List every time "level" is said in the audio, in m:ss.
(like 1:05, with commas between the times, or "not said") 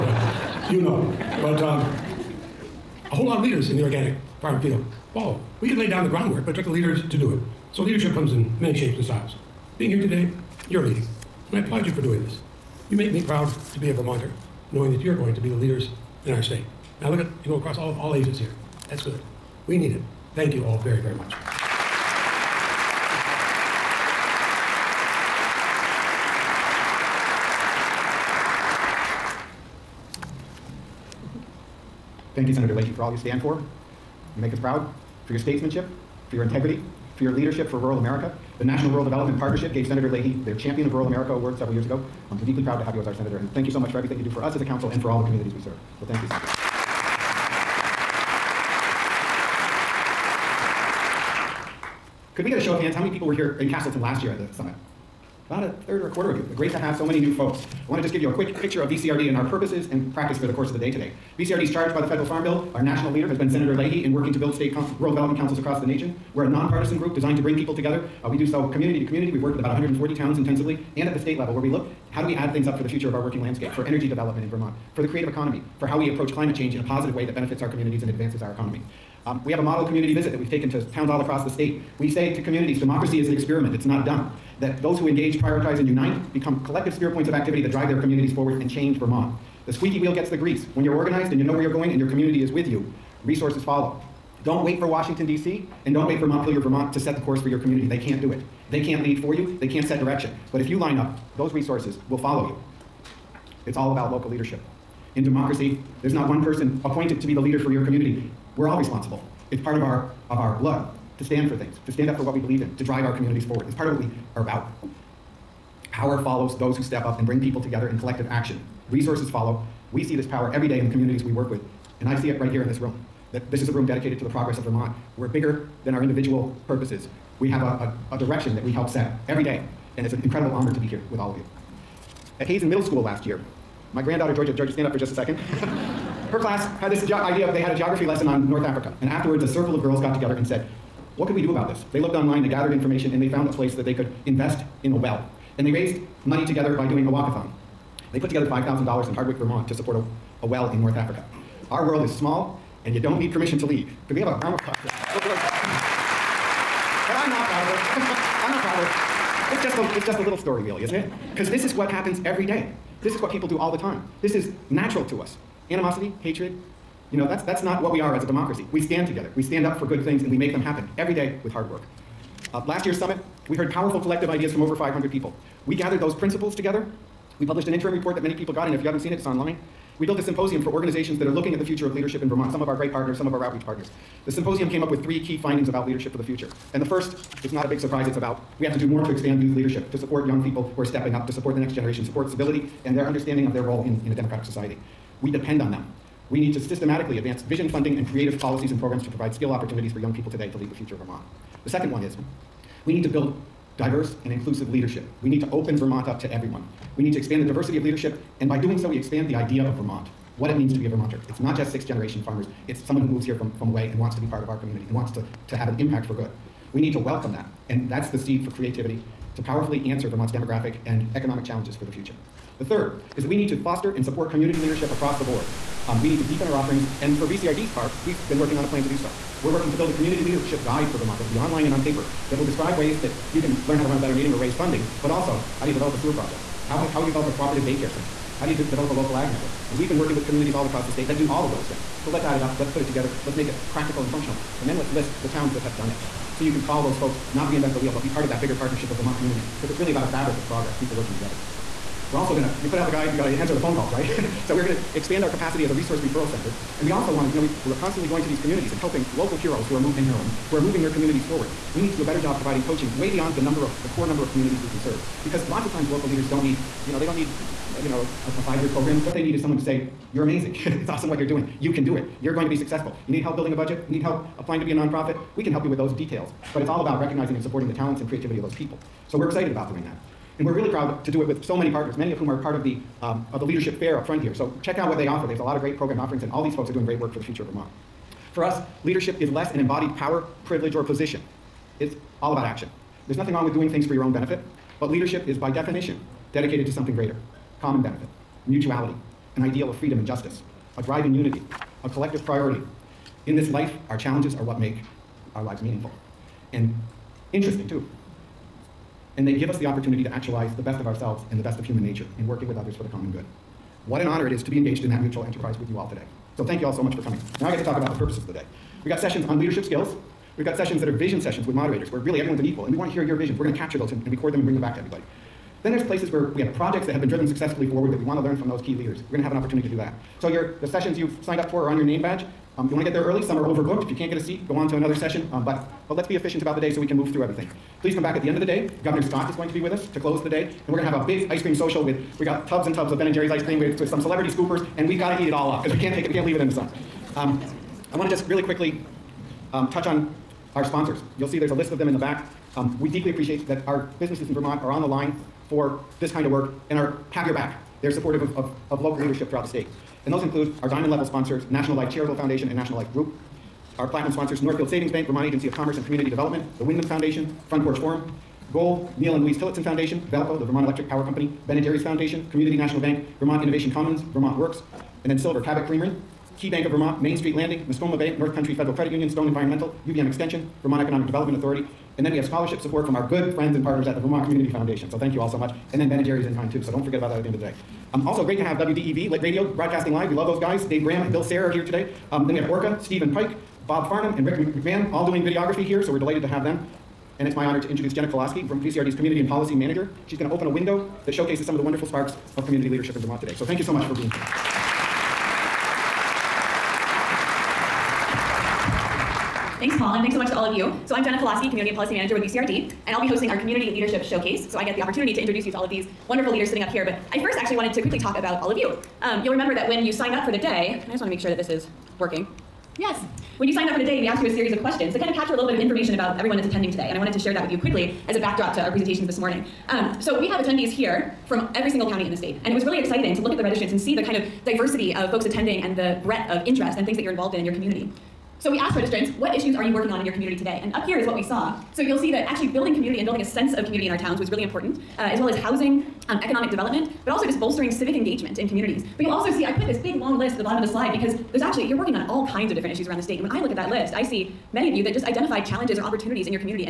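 1:11, 6:00.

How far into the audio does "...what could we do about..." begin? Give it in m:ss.
2:21.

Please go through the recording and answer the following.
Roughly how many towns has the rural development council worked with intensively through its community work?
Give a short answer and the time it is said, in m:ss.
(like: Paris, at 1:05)
140, at 1:09.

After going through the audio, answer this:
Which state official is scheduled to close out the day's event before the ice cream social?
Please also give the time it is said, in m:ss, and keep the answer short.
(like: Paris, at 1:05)
Governor Scott, at 5:38.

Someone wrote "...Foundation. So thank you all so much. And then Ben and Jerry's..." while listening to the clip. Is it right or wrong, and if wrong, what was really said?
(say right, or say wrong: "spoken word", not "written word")
right.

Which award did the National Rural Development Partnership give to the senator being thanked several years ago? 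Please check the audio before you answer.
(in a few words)
Champion of Rural America.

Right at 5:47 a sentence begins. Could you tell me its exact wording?
Um, I want to just really quickly um, touch on our sponsors.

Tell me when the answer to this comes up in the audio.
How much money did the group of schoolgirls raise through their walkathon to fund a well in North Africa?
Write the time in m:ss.
2:28.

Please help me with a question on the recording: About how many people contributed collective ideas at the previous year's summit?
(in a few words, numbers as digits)
500.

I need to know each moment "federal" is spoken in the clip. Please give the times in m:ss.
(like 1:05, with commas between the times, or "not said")
1:02, 6:18.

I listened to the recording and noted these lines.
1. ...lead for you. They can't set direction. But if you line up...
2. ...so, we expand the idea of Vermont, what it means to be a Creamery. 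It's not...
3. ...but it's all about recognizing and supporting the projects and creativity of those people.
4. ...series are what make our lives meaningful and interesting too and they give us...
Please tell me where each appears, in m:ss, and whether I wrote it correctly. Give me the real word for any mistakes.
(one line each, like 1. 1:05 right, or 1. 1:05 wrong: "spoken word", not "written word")
1. 1:39 right
2. 3:28 wrong: "Vermonter", not "Creamery"
3. 4:36 wrong: "talents", not "projects"
4. 5:03 wrong: "challenges", not "series".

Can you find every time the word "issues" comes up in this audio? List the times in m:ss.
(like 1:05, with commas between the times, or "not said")
7:19, 7:32.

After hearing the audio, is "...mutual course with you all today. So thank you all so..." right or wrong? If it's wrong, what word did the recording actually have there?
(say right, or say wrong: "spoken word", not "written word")
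wrong: "enterprise", not "course".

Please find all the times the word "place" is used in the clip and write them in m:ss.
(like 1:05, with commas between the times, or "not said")
2:23, 5:25.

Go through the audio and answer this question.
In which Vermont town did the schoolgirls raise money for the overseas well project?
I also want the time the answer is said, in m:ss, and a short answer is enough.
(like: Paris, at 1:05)
Hardwick, at 2:29.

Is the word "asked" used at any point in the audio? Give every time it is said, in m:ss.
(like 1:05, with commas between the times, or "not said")
7:04, 7:18.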